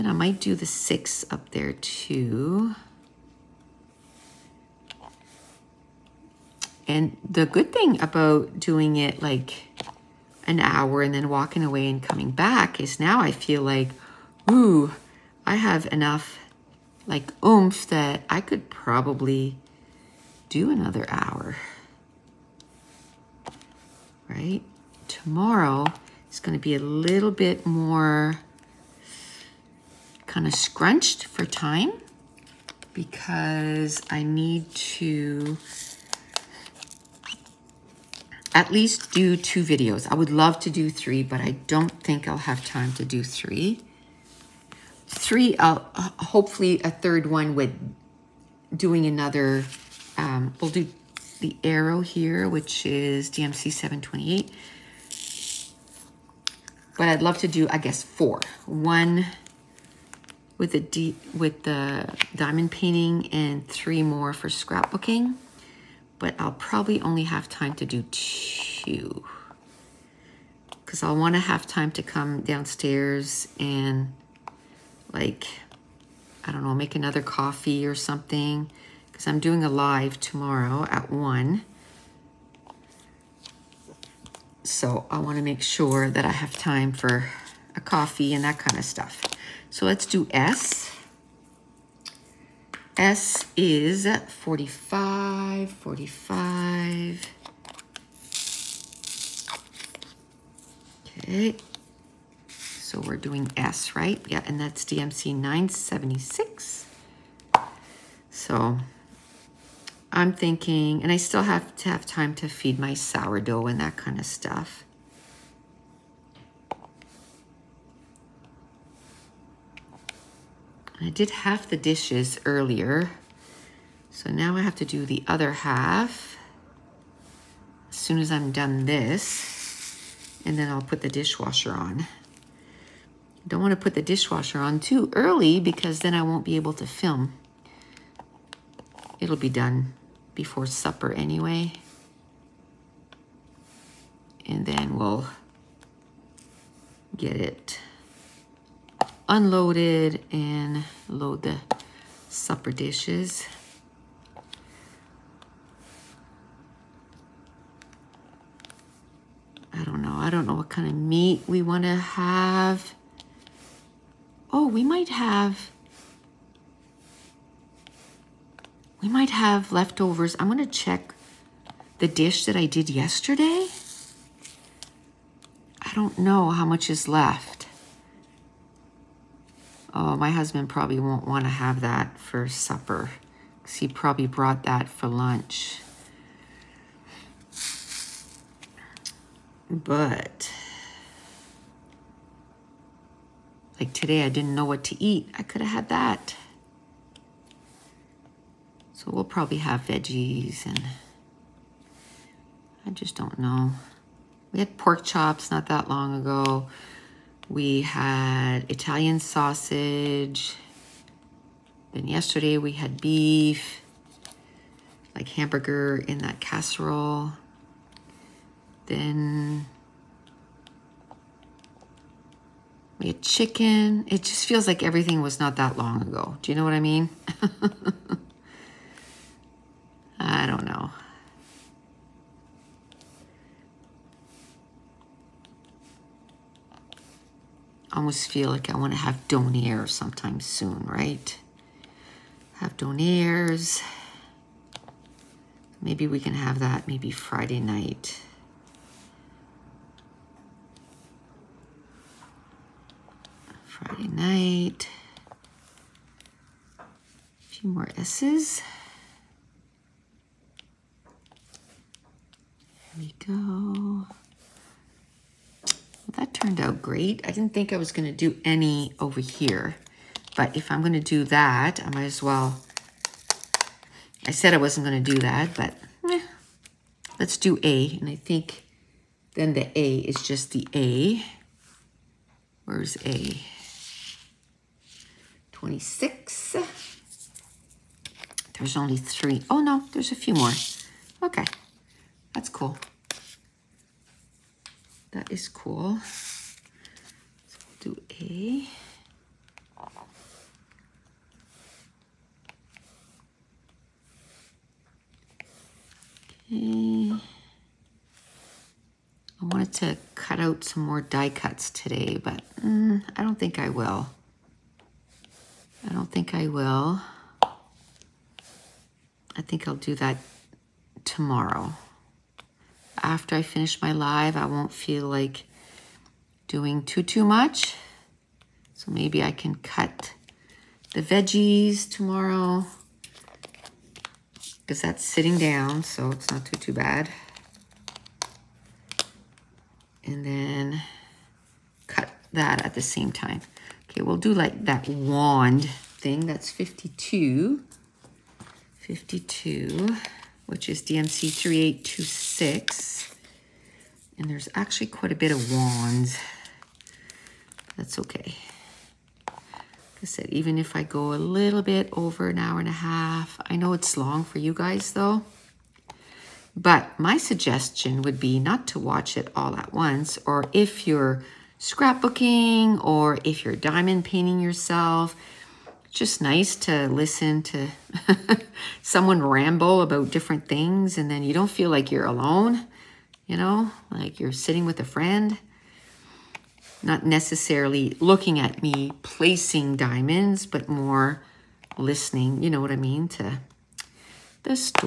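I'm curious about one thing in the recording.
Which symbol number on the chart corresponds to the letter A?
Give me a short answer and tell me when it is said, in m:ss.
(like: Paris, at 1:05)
26, at 4:45.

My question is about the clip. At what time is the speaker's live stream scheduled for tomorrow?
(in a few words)
1.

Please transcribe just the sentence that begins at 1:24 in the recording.
So I want to make sure that I have time for a coffee and that kind of stuff.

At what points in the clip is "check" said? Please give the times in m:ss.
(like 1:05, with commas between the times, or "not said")
2:50.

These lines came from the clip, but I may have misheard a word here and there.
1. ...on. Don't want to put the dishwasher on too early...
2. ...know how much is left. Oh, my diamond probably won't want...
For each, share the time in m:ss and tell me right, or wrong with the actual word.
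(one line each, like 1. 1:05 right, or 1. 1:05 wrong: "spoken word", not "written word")
1. 2:11 right
2. 2:56 wrong: "husband", not "diamond".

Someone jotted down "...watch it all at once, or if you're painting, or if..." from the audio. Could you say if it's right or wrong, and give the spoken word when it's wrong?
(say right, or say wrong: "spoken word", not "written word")
wrong: "scrapbooking", not "painting".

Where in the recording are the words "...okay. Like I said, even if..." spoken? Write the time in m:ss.
5:57.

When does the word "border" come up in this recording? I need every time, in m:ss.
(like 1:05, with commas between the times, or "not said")
not said.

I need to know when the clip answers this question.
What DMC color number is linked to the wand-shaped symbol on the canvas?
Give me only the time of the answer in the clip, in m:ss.
5:50.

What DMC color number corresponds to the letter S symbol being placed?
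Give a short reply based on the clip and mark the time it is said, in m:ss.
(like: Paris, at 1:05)
976, at 1:44.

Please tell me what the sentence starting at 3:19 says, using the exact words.
So we'll probably have veggies and I just don't know.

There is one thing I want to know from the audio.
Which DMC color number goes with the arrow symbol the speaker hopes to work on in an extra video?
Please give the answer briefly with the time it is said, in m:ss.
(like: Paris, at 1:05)
728, at 0:53.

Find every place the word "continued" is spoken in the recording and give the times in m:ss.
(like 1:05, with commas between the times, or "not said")
not said.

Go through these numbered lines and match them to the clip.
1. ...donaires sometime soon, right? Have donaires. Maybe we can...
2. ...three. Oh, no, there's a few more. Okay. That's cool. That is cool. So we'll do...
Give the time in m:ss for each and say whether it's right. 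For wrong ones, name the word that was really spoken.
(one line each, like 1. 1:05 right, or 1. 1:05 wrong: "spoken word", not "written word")
1. 3:59 right
2. 4:48 right.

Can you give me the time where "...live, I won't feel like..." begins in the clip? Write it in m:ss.
5:23.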